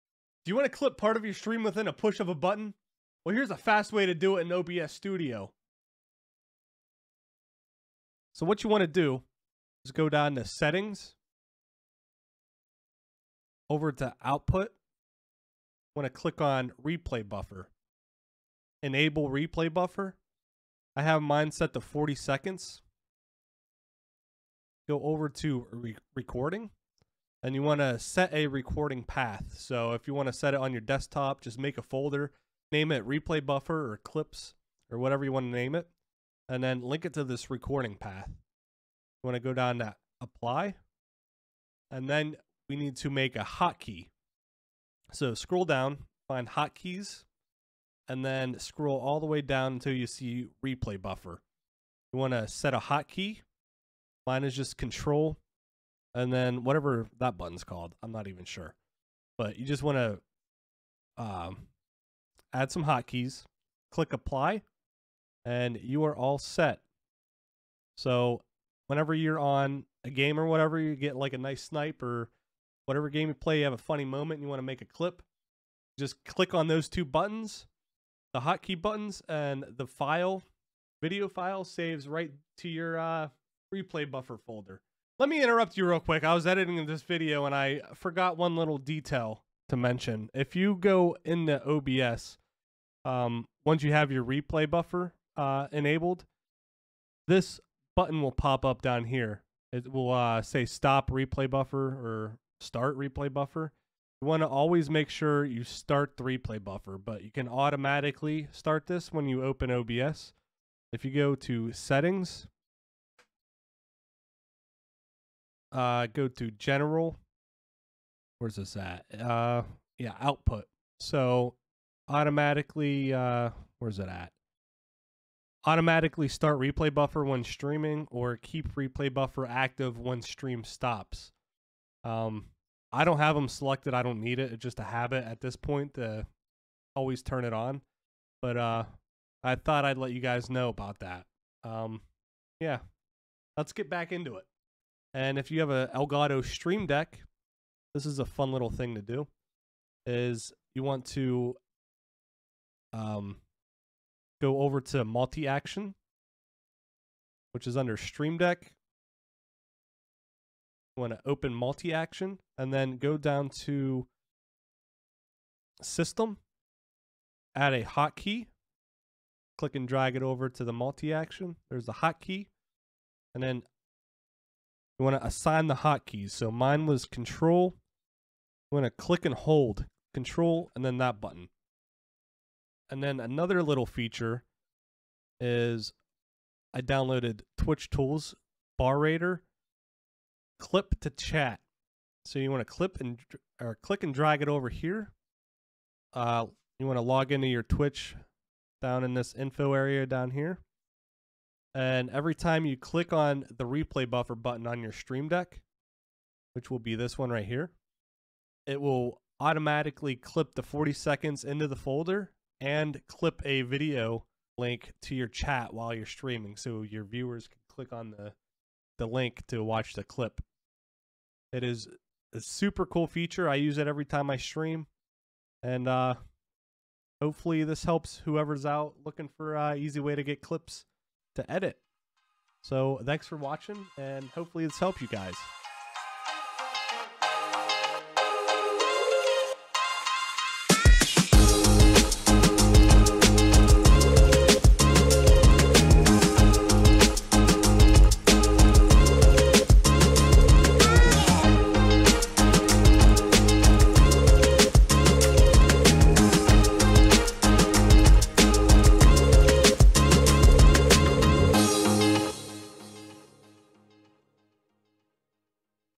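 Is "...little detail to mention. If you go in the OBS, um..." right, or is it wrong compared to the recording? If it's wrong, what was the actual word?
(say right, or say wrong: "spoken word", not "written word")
right.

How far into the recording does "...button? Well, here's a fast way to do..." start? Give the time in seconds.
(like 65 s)
2 s.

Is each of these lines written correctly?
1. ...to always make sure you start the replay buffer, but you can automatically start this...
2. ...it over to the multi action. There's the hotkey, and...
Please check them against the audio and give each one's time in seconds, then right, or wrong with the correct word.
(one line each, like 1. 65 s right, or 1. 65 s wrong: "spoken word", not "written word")
1. 104 s right
2. 170 s right.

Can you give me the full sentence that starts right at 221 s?
It is a super cool feature.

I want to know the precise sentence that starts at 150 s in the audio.
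Is you want to um, go over to multi action, which is under Stream Deck.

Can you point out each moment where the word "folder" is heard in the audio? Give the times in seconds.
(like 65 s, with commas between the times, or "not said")
31 s, 84 s, 211 s.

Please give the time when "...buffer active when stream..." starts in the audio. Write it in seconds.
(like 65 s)
129 s.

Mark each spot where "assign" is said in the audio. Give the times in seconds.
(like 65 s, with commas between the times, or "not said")
175 s.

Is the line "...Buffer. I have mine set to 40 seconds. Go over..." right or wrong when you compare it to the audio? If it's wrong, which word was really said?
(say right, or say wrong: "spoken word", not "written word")
right.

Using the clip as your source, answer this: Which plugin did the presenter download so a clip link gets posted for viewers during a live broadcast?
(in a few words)
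Twitch Tools BarRaider clip to chat.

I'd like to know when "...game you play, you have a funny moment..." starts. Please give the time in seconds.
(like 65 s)
73 s.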